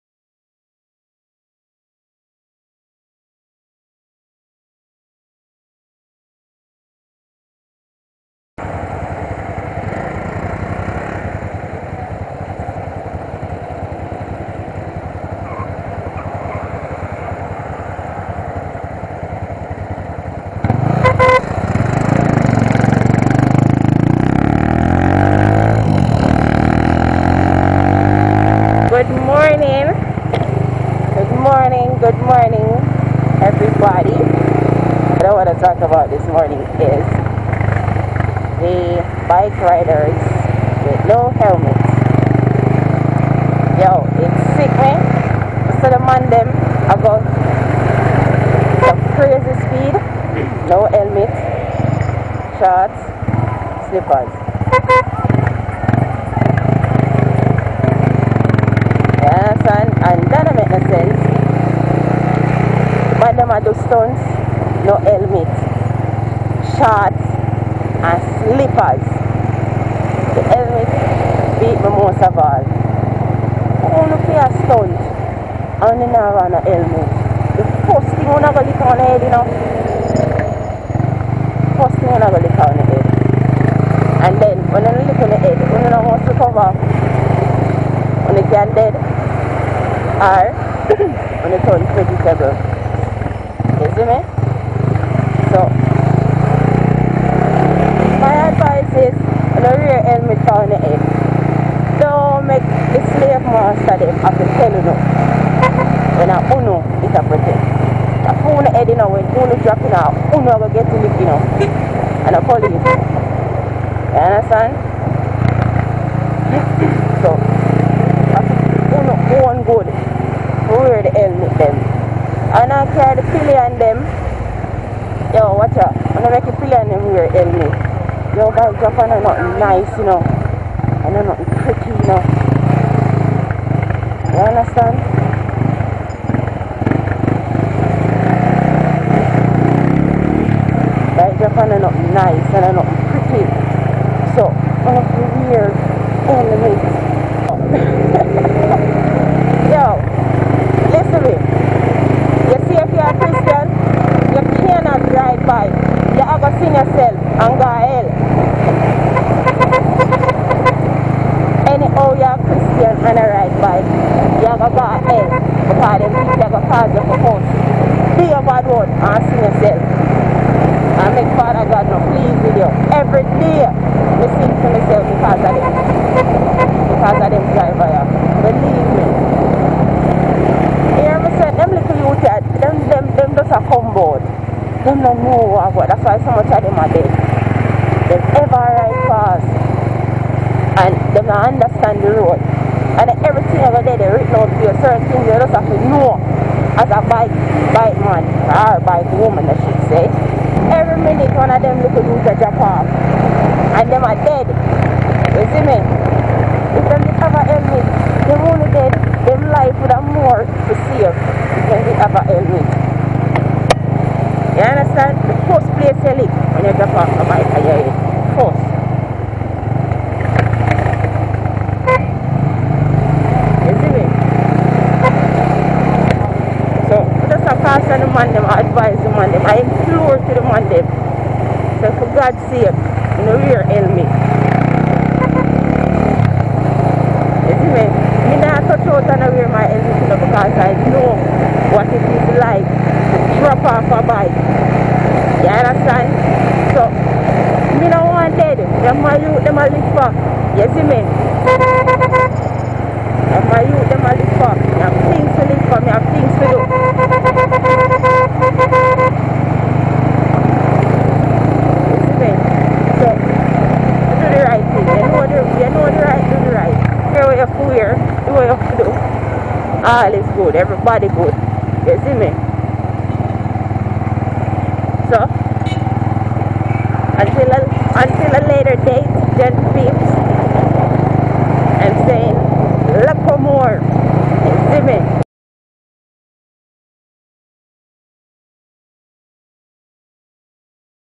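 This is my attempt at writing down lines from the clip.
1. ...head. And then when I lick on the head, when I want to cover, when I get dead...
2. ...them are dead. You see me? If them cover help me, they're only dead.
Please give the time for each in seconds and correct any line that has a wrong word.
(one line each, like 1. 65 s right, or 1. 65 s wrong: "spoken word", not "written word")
1. 82 s right
2. 203 s wrong: "discover", not "cover".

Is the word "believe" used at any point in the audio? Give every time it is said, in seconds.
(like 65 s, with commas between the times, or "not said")
156 s, 178 s.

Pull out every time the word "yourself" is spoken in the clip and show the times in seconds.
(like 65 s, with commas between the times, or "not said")
156 s, 169 s.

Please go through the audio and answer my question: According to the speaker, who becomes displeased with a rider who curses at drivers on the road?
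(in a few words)
Father God.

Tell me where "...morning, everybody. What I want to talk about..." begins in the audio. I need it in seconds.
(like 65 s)
32 s.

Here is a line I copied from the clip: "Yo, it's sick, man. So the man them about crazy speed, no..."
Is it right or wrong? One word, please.
right.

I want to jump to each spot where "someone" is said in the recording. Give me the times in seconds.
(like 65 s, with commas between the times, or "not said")
186 s.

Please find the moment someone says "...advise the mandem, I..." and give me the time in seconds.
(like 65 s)
228 s.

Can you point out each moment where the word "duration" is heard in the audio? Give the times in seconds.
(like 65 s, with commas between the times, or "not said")
not said.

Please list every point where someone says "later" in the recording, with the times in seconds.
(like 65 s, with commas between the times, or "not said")
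278 s.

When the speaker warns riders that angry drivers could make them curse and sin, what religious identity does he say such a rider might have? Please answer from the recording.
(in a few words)
Christian.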